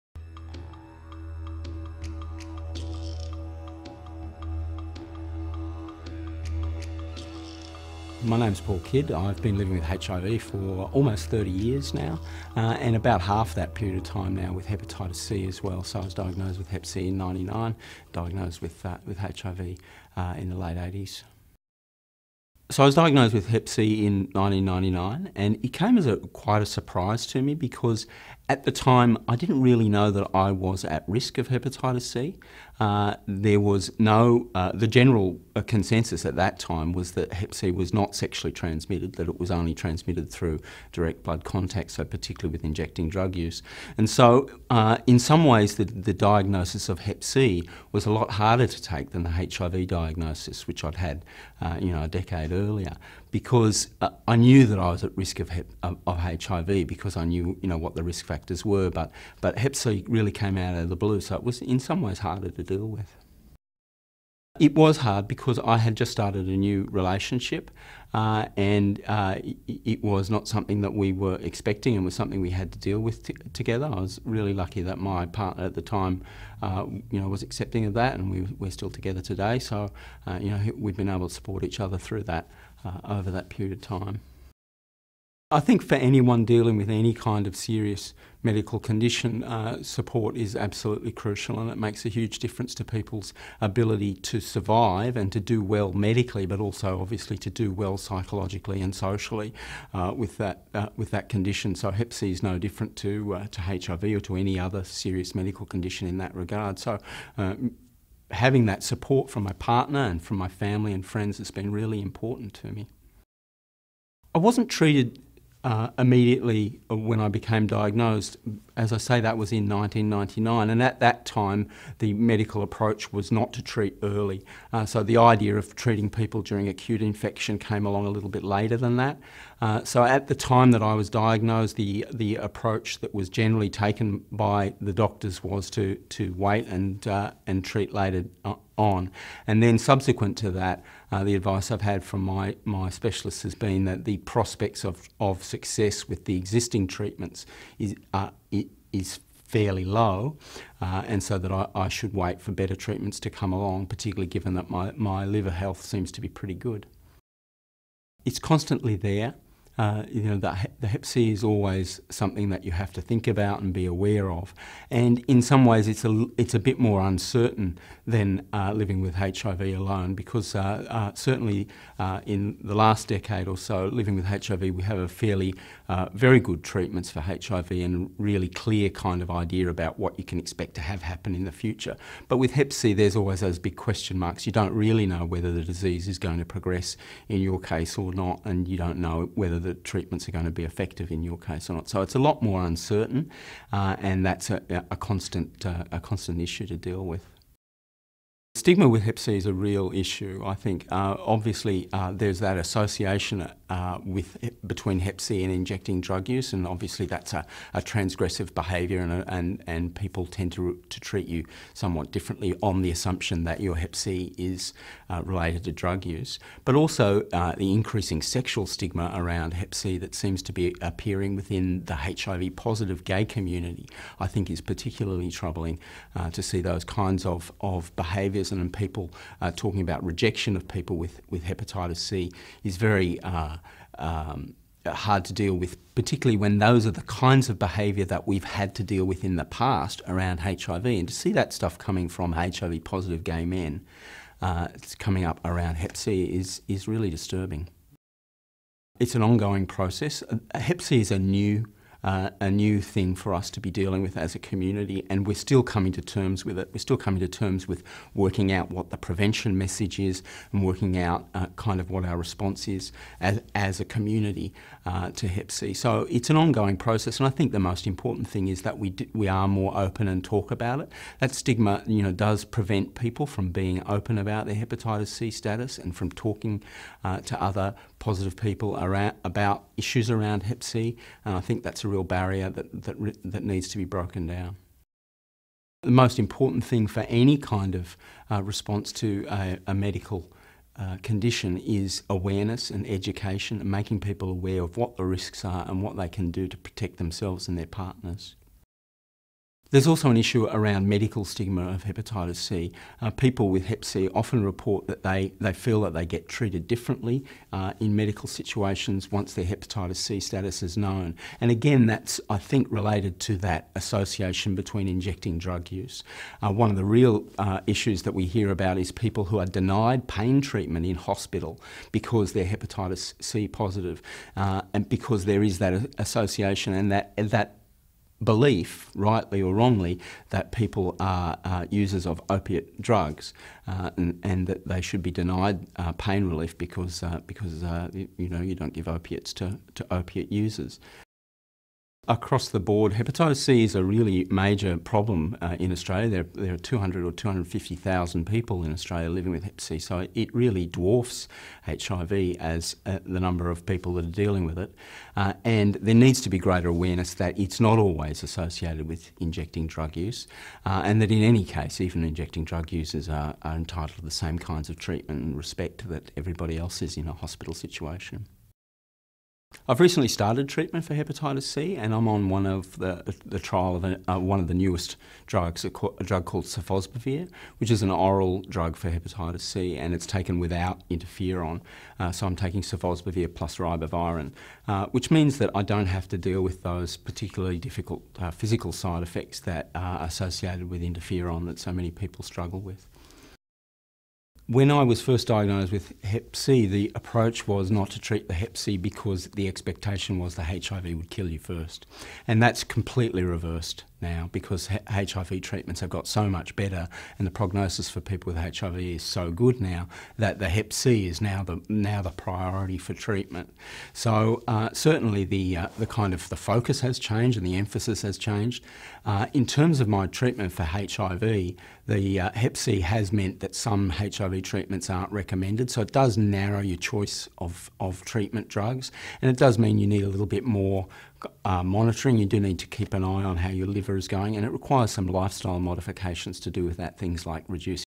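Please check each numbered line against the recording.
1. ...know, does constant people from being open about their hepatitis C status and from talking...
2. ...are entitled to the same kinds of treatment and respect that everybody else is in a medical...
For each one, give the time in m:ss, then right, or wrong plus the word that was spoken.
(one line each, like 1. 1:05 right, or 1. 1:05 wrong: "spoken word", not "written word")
1. 4:32 wrong: "prevent", not "constant"
2. 6:03 wrong: "hospital", not "medical".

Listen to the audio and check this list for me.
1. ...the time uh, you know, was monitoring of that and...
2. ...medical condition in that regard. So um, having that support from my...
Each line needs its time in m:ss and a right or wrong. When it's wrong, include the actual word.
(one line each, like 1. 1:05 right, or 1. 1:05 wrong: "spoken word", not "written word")
1. 1:15 wrong: "accepting", not "monitoring"
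2. 1:45 right.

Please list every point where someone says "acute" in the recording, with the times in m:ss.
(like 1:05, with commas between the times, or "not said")
2:06.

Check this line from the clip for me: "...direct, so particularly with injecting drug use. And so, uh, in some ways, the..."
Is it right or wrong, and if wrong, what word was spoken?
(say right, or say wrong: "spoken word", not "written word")
wrong: "contact", not "direct".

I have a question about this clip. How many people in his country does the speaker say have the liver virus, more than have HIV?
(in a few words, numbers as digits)
200,000 or 250,000.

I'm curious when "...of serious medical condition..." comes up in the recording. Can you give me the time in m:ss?
1:27.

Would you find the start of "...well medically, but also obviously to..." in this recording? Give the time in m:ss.
1:35.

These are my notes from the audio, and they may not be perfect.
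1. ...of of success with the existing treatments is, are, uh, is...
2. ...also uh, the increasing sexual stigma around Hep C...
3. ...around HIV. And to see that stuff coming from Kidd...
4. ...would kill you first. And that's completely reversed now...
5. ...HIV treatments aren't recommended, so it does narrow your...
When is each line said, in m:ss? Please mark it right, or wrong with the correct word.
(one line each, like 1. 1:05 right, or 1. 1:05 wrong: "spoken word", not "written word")
1. 2:24 right
2. 3:36 right
3. 4:00 wrong: "HIV", not "Kidd"
4. 6:40 right
5. 7:03 right.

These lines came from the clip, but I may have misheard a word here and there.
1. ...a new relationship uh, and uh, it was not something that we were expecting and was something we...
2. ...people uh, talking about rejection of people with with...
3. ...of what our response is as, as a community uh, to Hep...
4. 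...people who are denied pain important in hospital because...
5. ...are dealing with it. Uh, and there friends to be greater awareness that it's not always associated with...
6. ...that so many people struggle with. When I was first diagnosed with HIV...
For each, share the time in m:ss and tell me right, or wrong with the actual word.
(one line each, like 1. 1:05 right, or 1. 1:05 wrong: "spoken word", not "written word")
1. 1:06 right
2. 3:48 right
3. 4:21 right
4. 5:18 wrong: "treatment", not "important"
5. 5:54 wrong: "needs", not "friends"
6. 6:31 wrong: "Hep", not "HIV".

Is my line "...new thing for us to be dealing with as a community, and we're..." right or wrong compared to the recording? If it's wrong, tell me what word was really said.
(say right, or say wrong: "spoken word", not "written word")
right.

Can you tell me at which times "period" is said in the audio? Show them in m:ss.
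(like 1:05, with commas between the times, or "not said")
0:13, 1:23.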